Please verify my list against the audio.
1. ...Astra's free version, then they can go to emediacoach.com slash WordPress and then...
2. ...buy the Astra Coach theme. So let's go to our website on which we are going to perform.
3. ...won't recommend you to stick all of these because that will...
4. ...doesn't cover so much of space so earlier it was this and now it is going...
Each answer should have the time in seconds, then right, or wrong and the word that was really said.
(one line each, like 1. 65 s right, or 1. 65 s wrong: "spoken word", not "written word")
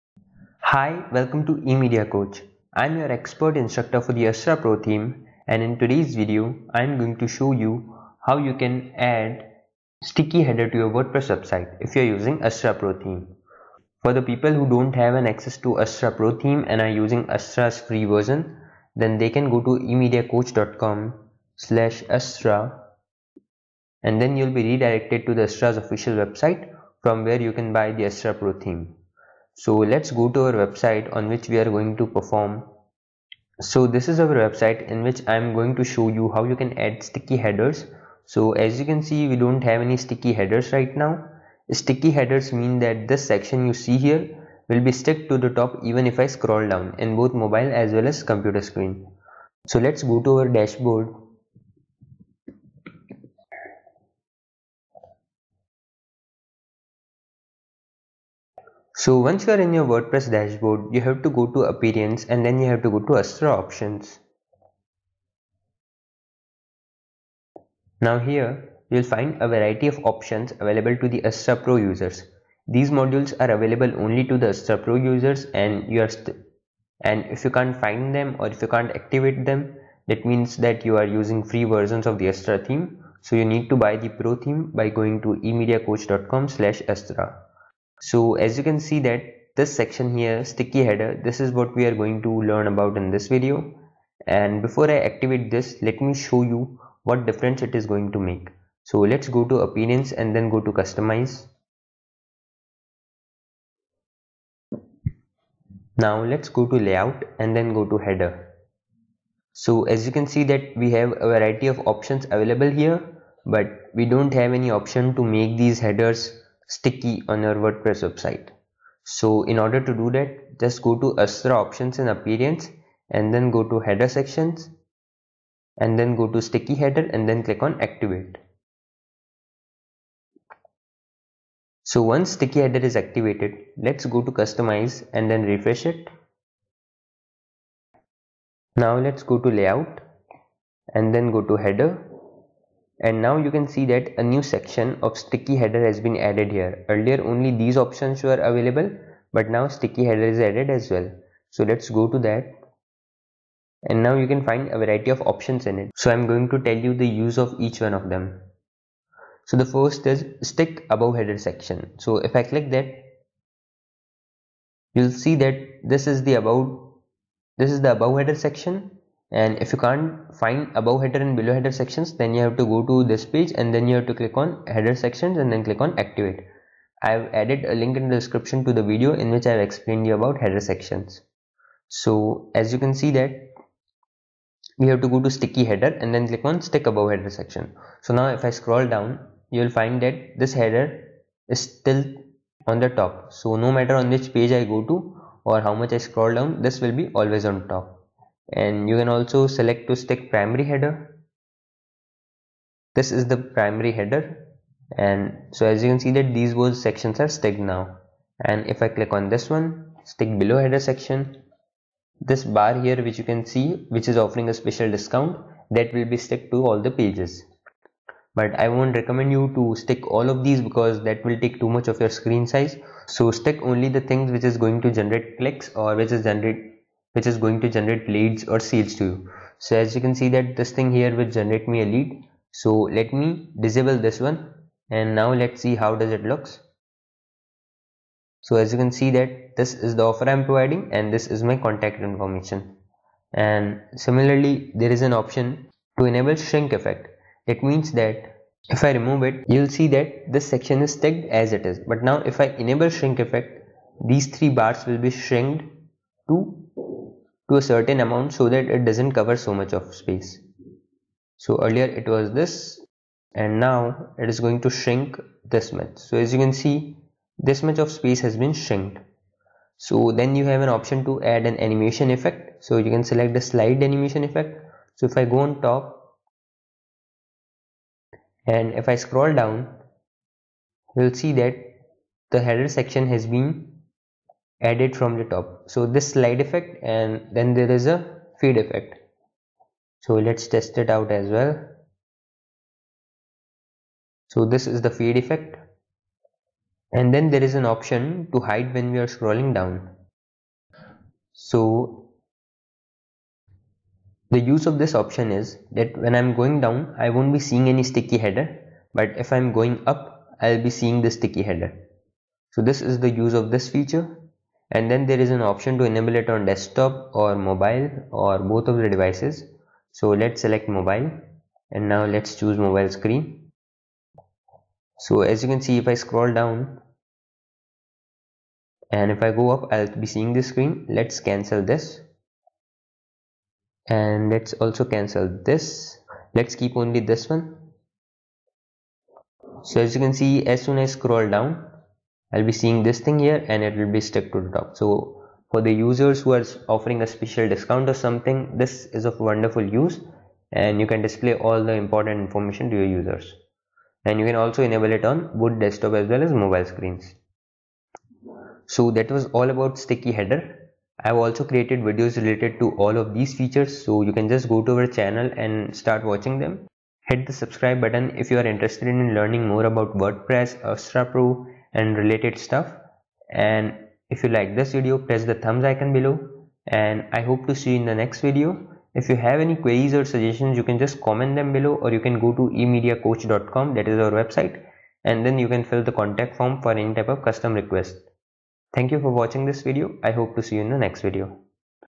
1. 17 s wrong: "Astra", not "WordPress"
2. 27 s wrong: "Pro", not "Coach"
3. 218 s right
4. 258 s right.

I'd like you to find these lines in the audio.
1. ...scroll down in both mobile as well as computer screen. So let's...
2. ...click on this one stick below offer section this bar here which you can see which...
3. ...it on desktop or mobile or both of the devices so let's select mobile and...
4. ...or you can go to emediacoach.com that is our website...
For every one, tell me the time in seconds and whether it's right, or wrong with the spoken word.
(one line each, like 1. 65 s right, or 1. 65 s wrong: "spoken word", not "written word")
1. 46 s right
2. 208 s wrong: "header", not "offer"
3. 316 s right
4. 381 s right.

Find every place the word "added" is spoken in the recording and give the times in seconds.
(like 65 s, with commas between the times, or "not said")
146 s, 150 s, 177 s, 284 s.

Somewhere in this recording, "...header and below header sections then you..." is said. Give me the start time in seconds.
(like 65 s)
171 s.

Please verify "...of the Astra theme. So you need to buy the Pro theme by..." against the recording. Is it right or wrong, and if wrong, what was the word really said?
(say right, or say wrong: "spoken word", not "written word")
right.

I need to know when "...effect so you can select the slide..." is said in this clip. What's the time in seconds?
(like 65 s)
272 s.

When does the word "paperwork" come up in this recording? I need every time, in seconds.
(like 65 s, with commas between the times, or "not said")
not said.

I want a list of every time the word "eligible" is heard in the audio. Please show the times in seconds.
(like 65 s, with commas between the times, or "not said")
not said.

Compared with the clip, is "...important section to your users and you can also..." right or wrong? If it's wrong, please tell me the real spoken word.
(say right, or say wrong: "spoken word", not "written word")
wrong: "information", not "section".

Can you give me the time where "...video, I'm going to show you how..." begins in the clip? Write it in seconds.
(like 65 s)
6 s.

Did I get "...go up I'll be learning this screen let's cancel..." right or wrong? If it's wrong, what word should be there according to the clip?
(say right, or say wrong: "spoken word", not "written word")
wrong: "seeing", not "learning".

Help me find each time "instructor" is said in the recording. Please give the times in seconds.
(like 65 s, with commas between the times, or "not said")
3 s.